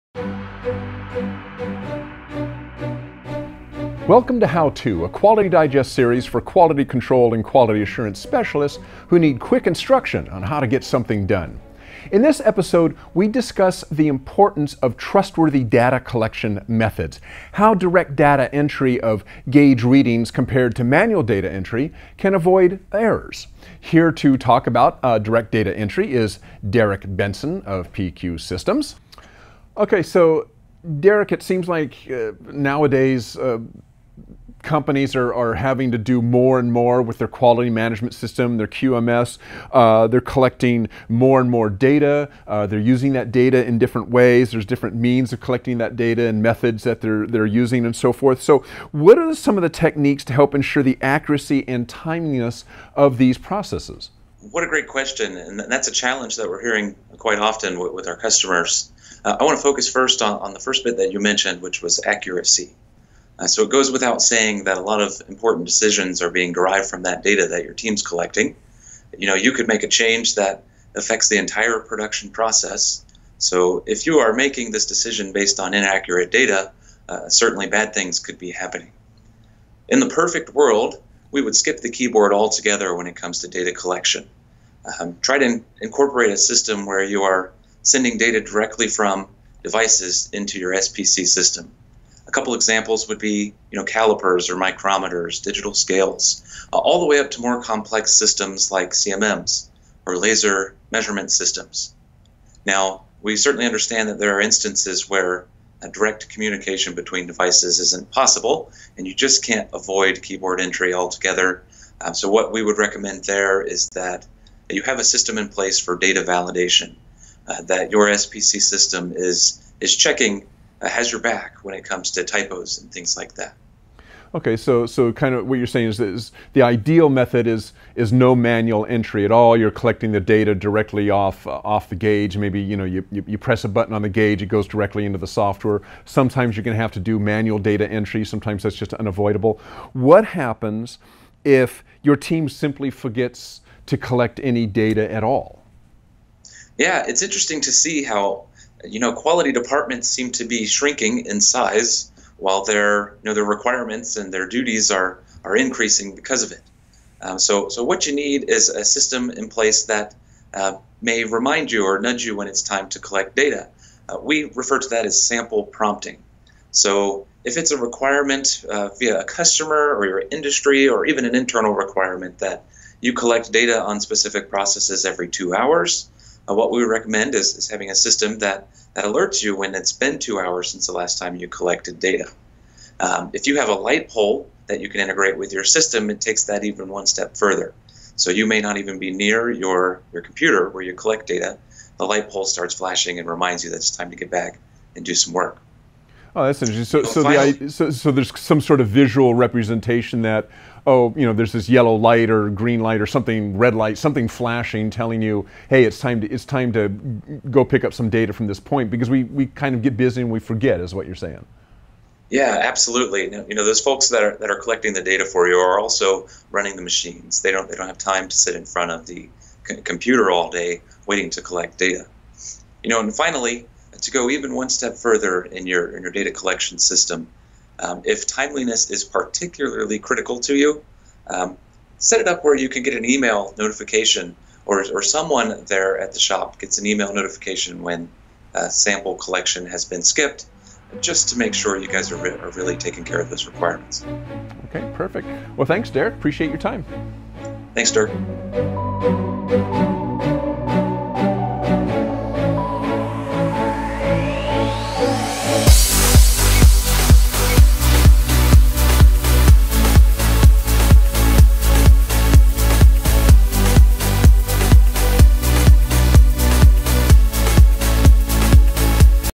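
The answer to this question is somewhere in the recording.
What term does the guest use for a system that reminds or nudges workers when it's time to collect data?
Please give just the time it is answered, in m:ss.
2:45.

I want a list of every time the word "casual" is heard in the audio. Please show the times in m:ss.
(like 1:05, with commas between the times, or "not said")
not said.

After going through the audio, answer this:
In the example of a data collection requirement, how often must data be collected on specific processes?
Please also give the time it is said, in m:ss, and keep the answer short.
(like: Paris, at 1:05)
every 2 hours, at 2:55.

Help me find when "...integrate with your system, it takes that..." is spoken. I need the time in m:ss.
3:05.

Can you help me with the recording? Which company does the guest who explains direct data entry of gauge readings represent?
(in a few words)
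PQ Systems.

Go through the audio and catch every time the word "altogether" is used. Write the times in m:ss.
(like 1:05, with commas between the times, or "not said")
1:22, 1:50.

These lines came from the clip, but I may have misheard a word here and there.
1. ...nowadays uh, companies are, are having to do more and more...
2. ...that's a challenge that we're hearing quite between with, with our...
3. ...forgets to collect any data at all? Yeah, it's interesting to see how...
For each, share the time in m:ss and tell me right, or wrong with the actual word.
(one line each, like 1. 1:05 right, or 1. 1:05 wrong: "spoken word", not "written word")
1. 0:32 right
2. 0:55 wrong: "often", not "between"
3. 2:22 right.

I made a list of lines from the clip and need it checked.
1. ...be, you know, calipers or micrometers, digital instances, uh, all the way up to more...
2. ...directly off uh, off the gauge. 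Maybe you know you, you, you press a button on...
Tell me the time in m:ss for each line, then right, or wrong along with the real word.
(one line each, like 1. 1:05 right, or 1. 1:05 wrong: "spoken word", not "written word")
1. 1:33 wrong: "scales", not "instances"
2. 2:10 right.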